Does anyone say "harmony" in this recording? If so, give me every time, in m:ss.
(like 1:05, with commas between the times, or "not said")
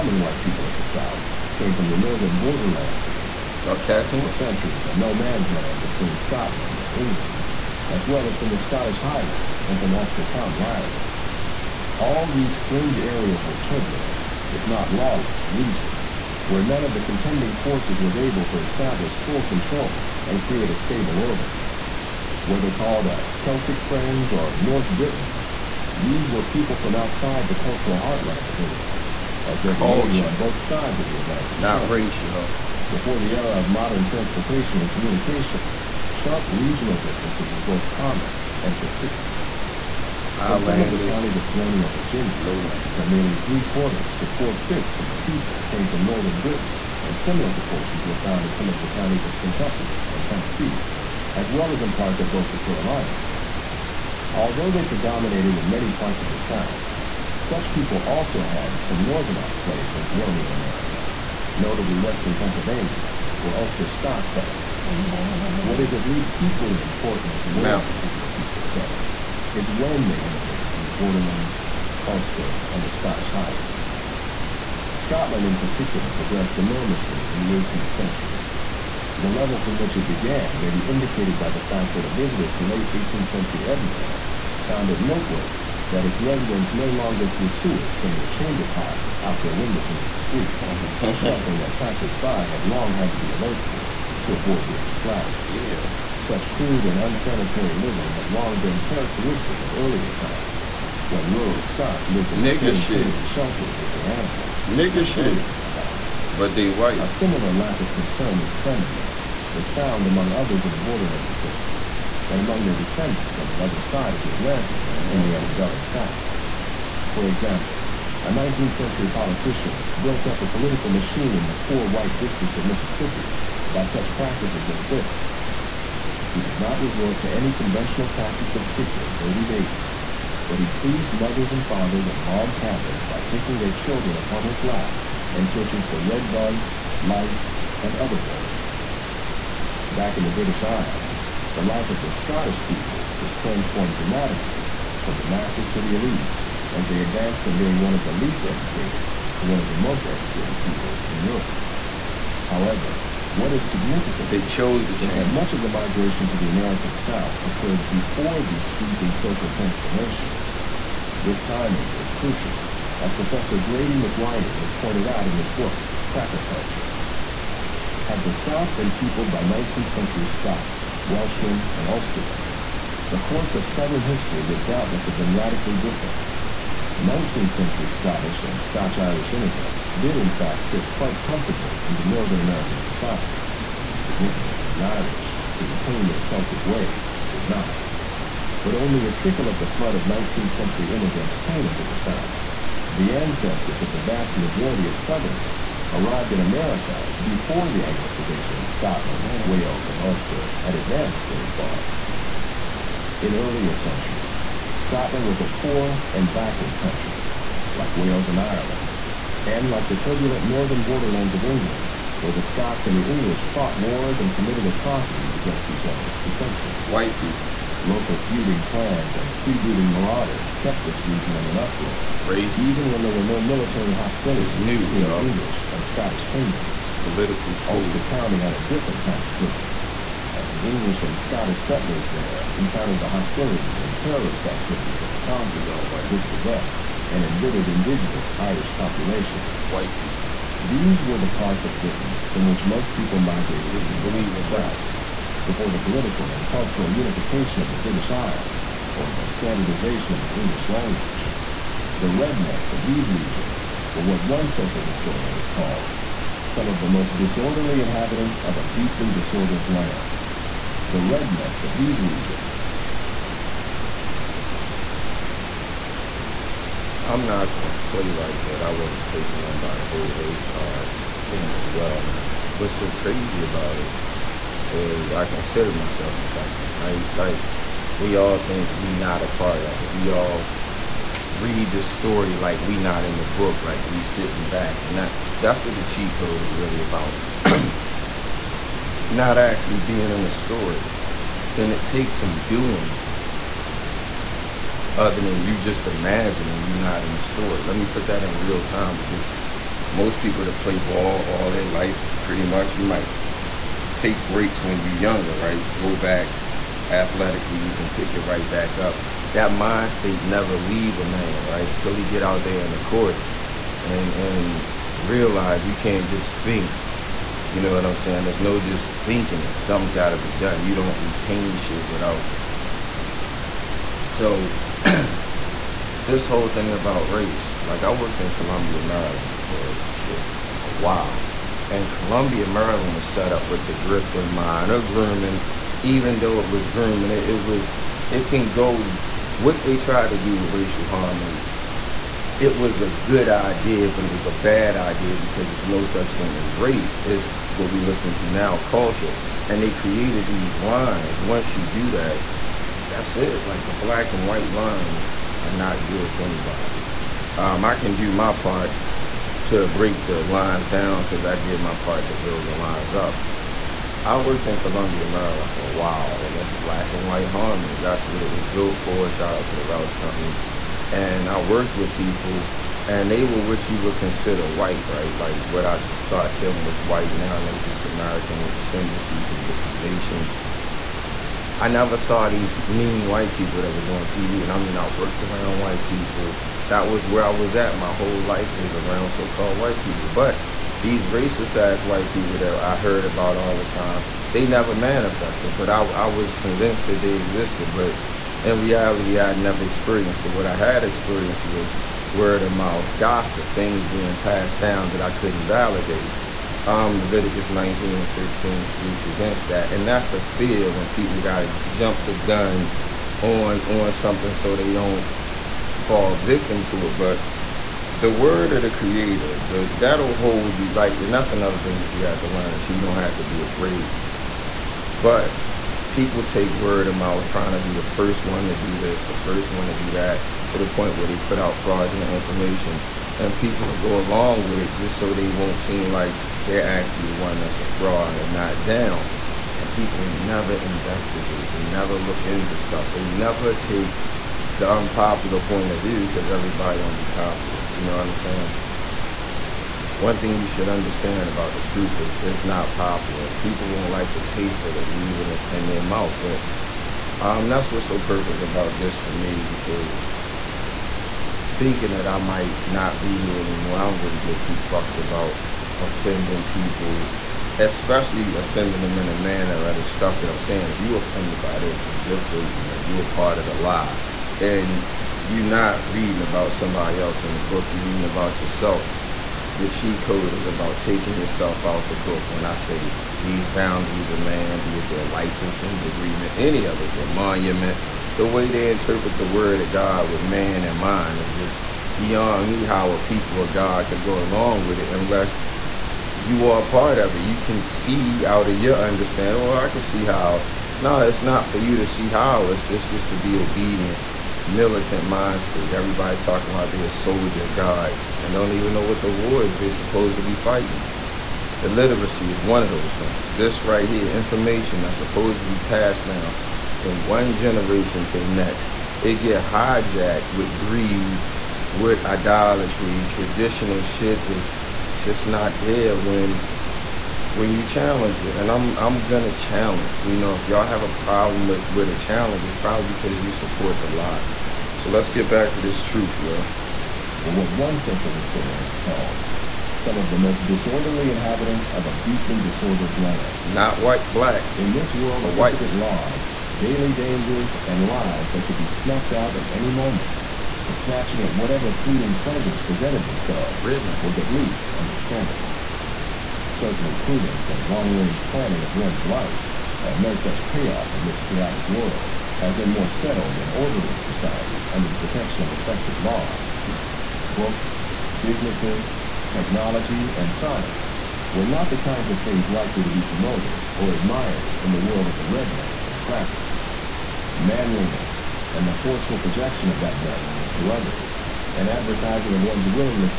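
5:40, 6:07.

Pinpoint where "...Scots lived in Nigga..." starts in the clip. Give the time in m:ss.
1:41.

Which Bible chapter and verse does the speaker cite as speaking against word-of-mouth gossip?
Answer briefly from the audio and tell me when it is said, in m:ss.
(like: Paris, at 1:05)
Leviticus 19:16, at 6:46.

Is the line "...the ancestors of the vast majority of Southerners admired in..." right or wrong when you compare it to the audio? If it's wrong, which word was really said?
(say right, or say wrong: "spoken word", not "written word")
wrong: "arrived", not "admired".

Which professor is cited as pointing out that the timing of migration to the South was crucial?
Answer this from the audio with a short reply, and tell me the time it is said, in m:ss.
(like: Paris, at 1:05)
Grady McWhiney, at 2:43.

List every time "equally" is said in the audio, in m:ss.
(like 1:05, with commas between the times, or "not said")
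1:06.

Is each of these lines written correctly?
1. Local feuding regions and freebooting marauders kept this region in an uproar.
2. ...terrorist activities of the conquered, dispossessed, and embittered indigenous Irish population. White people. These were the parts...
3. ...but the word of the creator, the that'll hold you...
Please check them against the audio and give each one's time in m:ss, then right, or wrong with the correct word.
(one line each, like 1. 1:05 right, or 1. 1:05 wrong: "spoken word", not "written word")
1. 3:37 wrong: "clans", not "regions"
2. 3:53 right
3. 6:56 right.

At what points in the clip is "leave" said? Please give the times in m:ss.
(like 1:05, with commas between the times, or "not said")
5:10, 7:34.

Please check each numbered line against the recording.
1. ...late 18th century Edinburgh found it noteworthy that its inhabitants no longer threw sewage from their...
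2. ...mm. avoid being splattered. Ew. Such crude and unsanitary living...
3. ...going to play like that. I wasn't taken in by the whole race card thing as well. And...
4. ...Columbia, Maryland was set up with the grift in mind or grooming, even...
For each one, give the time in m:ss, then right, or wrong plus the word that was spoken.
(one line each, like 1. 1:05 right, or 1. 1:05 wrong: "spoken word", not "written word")
1. 1:22 wrong: "residents", not "inhabitants"
2. 1:34 right
3. 4:27 right
4. 5:31 right.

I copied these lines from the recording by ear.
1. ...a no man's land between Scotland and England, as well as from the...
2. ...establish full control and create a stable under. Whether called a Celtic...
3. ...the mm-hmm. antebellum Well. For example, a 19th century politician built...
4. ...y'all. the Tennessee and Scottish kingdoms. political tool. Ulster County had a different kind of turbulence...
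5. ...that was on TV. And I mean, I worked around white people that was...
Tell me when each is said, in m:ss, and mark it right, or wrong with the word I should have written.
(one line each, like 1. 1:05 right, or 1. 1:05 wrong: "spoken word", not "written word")
1. 0:04 right
2. 0:18 wrong: "order", not "under"
3. 1:55 wrong: "South", not "Well"
4. 3:45 wrong: "English", not "Tennessee"
5. 6:23 right.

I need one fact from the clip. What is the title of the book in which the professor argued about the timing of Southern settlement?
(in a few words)
Cracker Culture.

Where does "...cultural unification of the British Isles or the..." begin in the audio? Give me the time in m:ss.
4:06.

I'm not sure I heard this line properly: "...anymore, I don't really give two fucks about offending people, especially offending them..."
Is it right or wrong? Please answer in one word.
right.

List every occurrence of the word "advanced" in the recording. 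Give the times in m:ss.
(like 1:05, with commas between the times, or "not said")
2:27, 3:20.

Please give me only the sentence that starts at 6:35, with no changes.
But I, I was convinced that they existed.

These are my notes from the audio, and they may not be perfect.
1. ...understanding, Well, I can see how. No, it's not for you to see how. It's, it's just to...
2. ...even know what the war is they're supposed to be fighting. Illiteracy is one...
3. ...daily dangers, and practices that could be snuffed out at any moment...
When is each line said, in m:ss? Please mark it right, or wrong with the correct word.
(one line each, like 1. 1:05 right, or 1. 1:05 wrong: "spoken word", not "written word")
1. 8:18 right
2. 8:28 right
3. 9:06 wrong: "lives", not "practices".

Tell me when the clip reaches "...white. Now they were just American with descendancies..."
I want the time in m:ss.
6:16.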